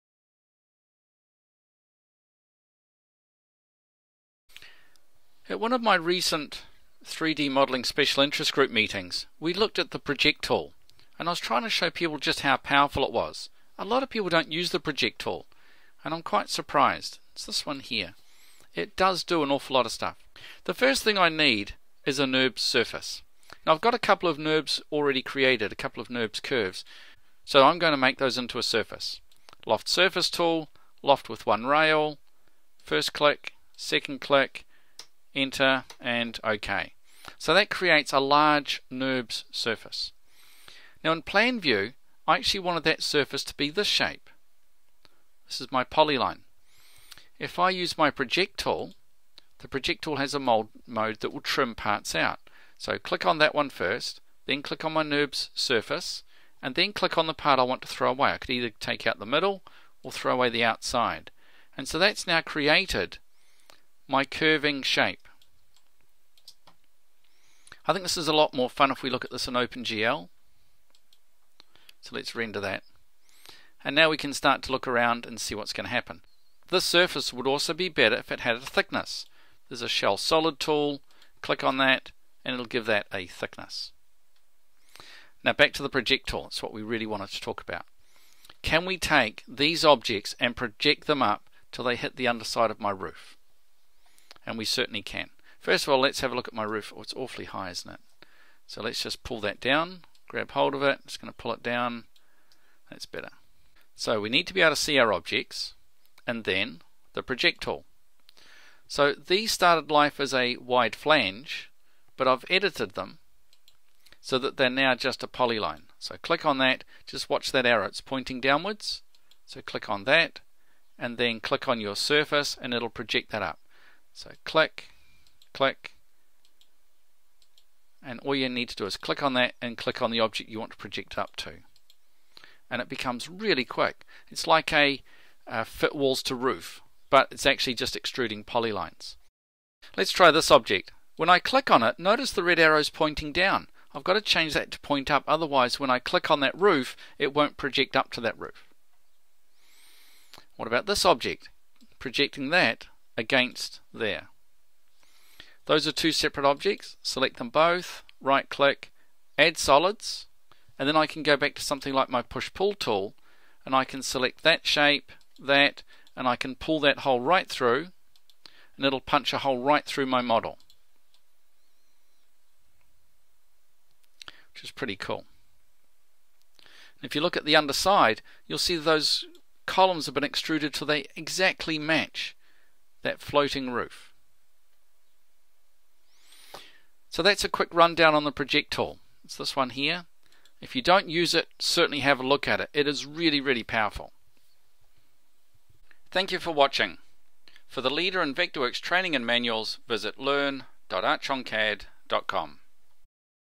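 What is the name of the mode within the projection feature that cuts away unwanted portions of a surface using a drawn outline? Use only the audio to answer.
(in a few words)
Mold mode.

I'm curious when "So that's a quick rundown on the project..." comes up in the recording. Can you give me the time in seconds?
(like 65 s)
187 s.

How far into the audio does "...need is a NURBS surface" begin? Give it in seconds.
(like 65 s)
21 s.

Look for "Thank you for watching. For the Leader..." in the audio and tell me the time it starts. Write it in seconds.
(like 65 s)
196 s.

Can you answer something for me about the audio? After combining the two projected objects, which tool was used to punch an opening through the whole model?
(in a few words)
Push pull tool.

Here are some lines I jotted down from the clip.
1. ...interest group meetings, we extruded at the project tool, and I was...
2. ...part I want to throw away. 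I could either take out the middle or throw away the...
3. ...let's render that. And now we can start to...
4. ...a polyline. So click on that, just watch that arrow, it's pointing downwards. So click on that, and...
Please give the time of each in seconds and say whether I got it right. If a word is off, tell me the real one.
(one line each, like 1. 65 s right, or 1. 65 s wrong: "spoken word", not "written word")
1. 8 s wrong: "looked", not "extruded"
2. 57 s right
3. 72 s right
4. 115 s right.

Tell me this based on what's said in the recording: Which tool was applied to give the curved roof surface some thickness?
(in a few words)
Shell Solid.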